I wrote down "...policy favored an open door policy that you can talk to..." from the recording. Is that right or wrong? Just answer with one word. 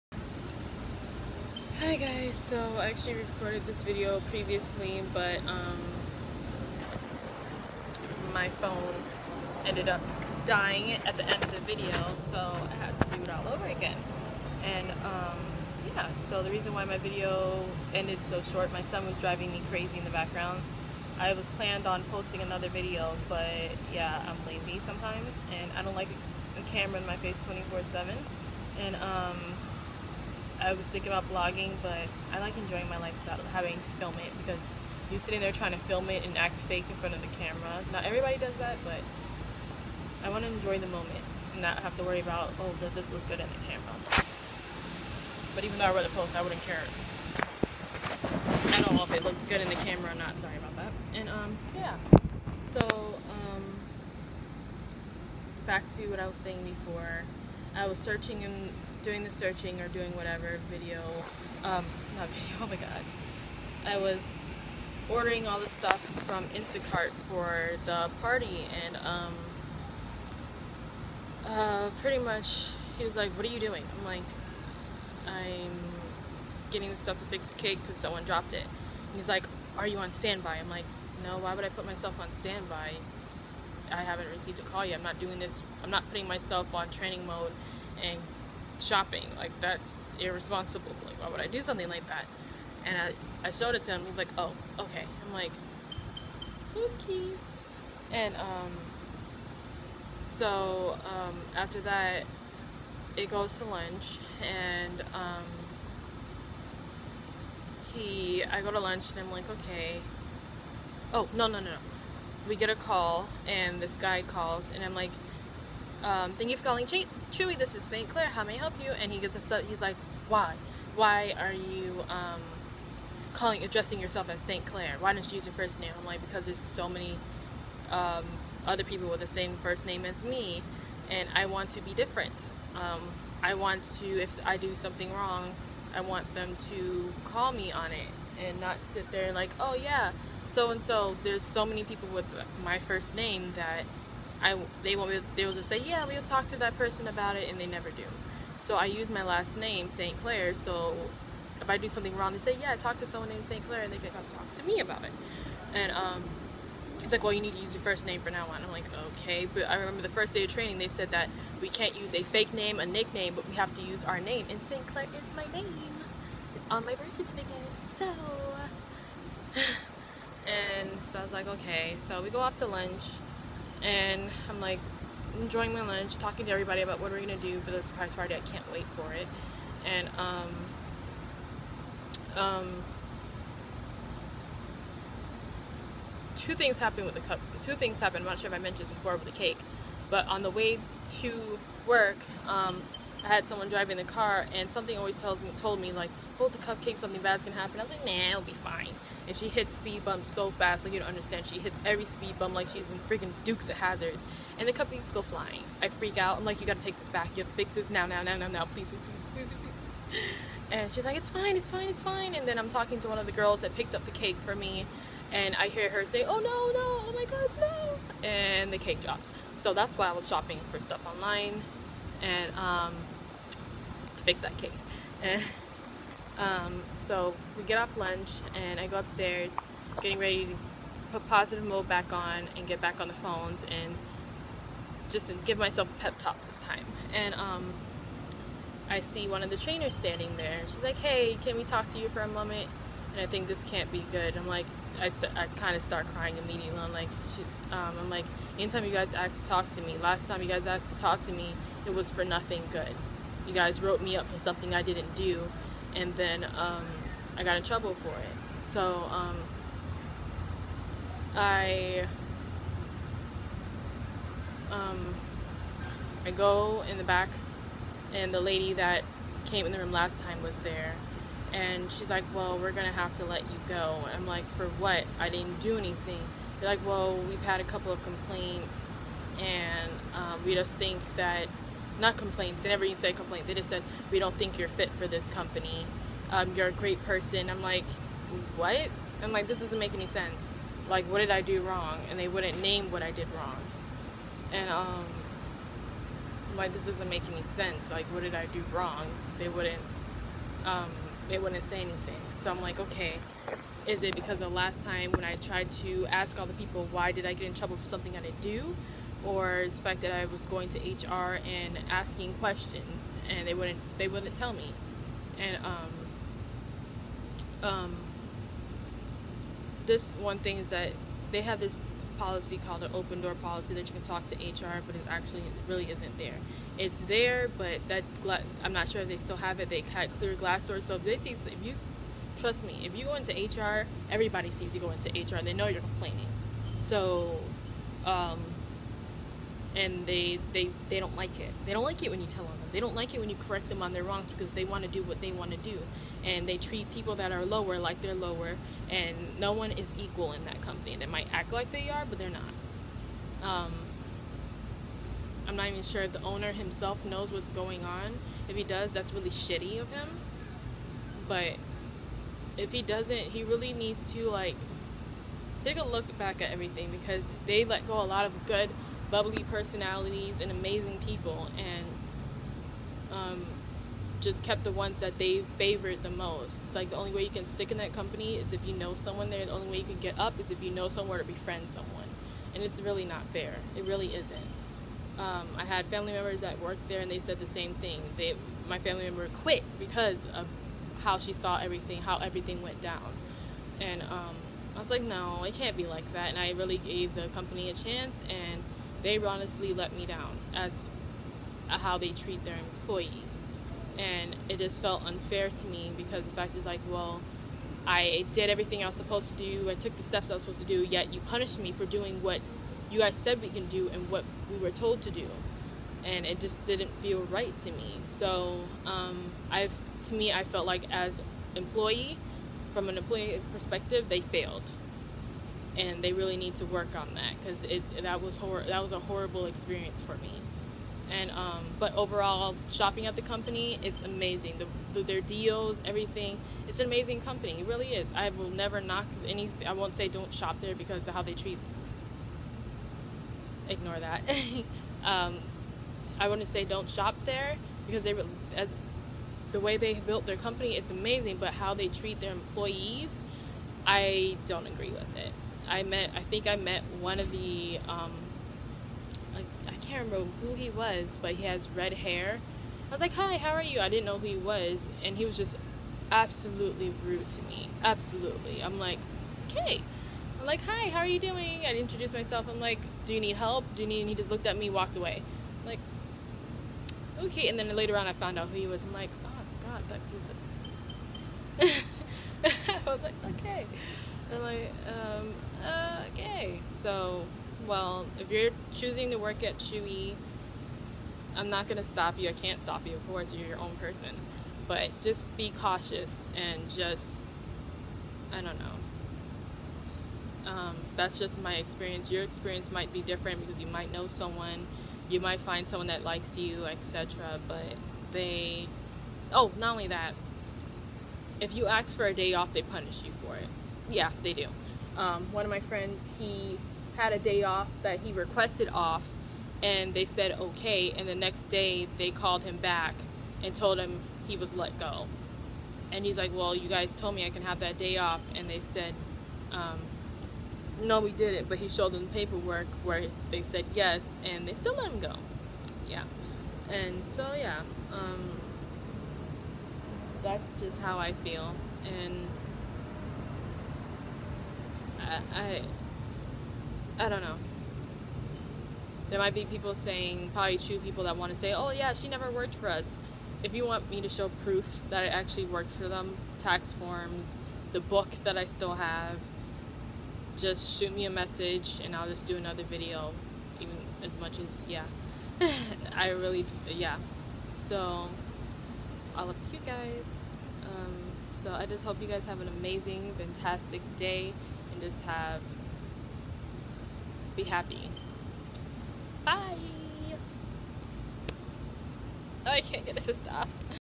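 wrong.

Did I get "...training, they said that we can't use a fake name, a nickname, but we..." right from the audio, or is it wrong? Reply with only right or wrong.
right.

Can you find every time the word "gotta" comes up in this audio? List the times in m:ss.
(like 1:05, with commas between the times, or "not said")
3:26.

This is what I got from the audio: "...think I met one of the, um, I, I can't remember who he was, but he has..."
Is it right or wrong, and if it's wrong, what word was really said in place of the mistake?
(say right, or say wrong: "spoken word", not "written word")
right.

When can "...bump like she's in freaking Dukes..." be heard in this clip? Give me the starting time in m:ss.
3:22.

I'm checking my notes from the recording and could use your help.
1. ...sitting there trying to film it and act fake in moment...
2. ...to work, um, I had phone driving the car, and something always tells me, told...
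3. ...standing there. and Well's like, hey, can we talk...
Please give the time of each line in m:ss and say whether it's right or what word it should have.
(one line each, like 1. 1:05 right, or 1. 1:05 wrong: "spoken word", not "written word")
1. 0:35 wrong: "front", not "moment"
2. 3:11 wrong: "someone", not "phone"
3. 3:59 wrong: "She", not "Well".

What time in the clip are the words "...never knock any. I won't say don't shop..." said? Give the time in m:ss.
7:18.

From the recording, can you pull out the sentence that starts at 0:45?
But even though I wrote the post, I wouldn't care at all if it looked good in the camera or not.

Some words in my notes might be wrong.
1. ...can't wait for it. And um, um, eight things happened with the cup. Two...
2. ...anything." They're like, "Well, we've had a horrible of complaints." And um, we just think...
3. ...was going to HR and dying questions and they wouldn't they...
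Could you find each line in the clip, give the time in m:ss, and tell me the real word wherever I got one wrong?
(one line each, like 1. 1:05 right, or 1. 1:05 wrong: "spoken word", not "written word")
1. 2:58 wrong: "two", not "eight"
2. 4:35 wrong: "couple", not "horrible"
3. 5:10 wrong: "asking", not "dying".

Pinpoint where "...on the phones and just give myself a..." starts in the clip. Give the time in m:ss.
3:52.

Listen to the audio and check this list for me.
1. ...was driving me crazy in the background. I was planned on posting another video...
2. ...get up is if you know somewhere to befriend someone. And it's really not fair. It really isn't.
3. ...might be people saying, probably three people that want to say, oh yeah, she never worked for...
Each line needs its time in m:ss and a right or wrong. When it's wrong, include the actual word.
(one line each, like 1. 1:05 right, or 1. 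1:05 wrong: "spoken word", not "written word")
1. 0:19 right
2. 6:19 right
3. 9:09 wrong: "two", not "three".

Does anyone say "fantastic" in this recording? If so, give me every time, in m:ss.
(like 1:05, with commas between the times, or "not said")
9:33.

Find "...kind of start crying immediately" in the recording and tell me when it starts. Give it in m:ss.
4:05.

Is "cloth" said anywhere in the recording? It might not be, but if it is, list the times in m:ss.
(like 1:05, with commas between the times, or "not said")
not said.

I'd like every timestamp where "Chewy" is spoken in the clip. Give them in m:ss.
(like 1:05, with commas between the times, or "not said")
1:57, 8:09.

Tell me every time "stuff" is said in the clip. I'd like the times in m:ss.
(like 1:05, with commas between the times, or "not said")
1:05, 1:16, 3:40.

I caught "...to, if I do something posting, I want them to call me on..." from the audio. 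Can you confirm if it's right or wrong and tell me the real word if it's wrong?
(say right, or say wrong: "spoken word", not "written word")
wrong: "wrong", not "posting".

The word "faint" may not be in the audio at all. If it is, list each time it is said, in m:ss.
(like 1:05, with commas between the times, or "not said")
not said.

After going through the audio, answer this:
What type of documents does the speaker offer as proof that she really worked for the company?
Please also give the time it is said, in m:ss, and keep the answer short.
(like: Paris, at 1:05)
Tax forms, at 9:16.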